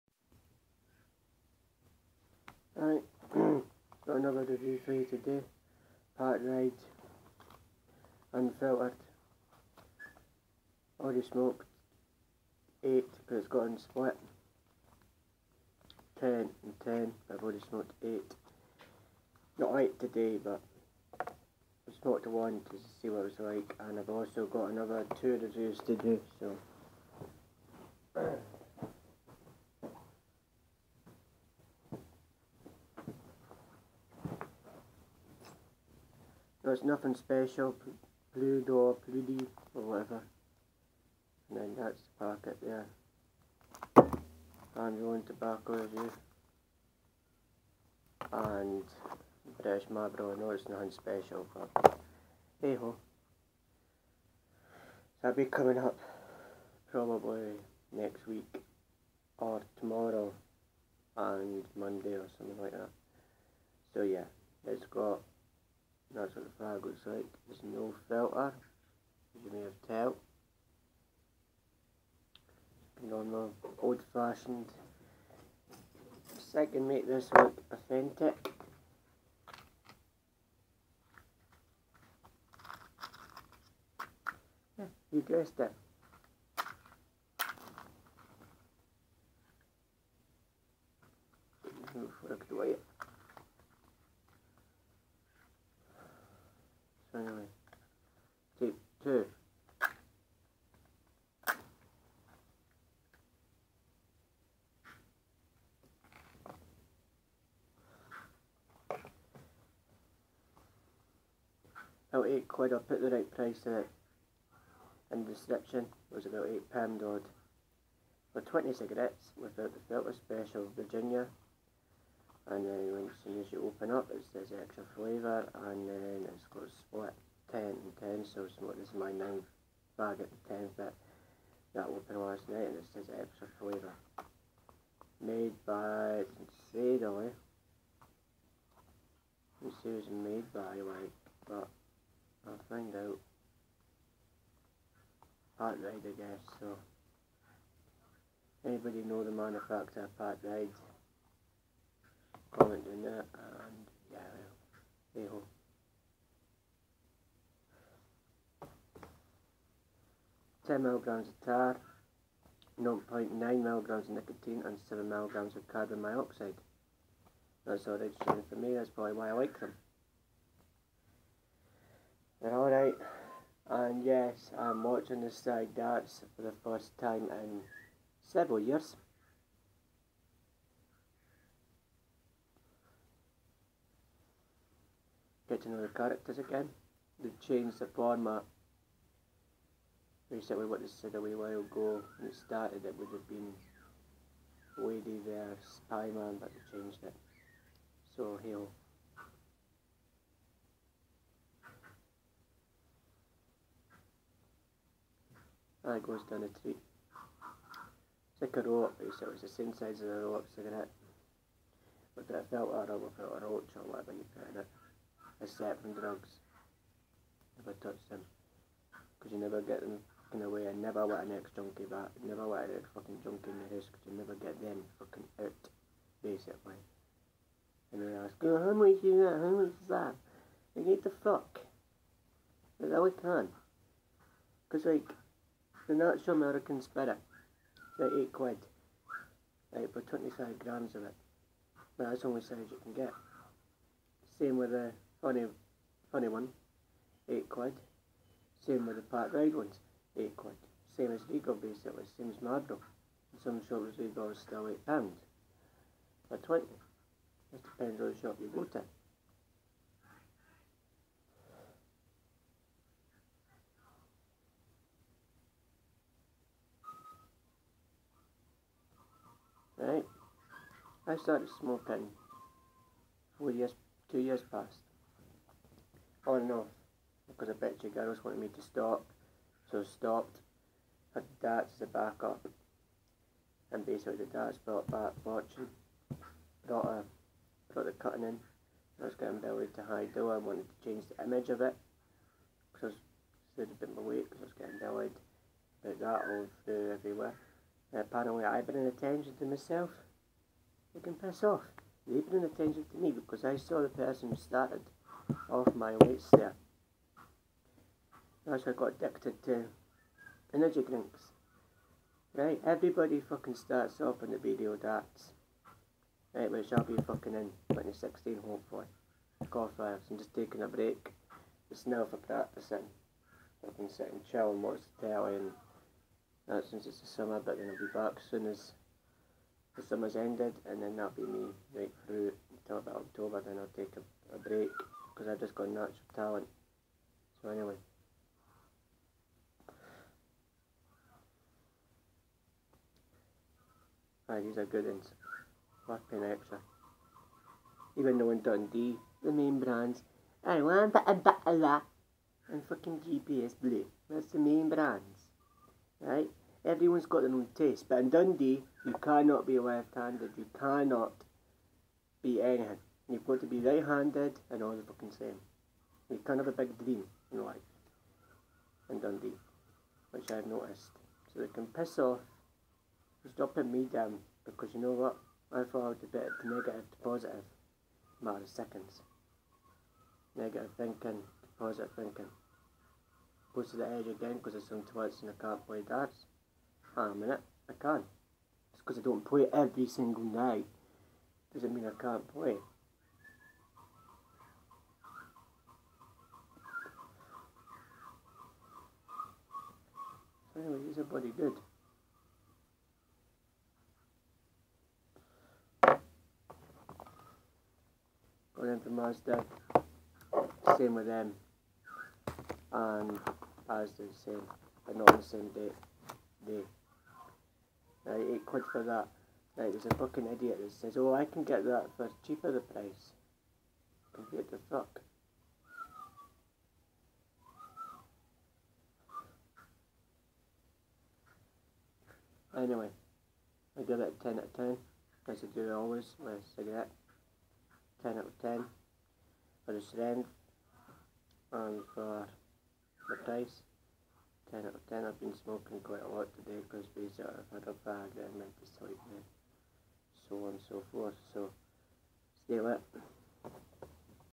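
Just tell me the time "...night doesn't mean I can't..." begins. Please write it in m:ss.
6:30.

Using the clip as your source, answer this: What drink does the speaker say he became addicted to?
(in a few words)
Energy drinks.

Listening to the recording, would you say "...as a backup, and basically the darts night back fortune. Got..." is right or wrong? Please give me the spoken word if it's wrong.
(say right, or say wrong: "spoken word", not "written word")
wrong: "brought", not "night".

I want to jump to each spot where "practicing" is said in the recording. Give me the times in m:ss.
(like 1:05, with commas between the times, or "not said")
5:22.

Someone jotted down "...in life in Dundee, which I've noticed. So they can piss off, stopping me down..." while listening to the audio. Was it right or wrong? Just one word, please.
right.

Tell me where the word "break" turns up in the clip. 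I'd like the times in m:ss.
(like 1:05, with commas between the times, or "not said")
5:20, 5:34.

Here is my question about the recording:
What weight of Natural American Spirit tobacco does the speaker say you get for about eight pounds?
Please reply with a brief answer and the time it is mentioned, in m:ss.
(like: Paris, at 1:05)
25 grams, at 4:00.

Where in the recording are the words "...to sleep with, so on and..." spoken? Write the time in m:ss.
7:28.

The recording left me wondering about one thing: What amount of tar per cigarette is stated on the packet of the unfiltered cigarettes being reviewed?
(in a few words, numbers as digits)
10 milligrams.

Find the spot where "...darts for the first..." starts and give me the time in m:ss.
2:55.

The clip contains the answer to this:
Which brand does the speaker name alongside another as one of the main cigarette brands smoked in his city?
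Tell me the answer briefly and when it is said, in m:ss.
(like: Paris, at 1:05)
JPS Blue, at 5:53.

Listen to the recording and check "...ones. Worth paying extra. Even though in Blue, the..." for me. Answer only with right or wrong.
wrong.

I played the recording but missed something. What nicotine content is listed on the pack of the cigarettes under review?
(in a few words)
0.9 milligrams.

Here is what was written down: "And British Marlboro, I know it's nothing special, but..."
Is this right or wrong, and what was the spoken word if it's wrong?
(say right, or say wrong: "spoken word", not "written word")
right.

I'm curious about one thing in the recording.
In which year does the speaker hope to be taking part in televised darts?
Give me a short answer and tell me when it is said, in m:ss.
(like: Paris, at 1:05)
2016, at 5:17.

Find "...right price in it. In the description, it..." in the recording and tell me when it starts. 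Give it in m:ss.
1:53.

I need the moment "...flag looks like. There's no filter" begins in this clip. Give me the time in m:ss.
1:06.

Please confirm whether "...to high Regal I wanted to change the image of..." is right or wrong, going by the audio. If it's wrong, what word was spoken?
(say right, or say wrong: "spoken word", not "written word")
wrong: "Though", not "Regal".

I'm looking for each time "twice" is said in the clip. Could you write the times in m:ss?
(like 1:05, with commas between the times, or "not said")
6:24.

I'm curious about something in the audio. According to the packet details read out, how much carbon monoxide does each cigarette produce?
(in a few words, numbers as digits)
7 milligrams.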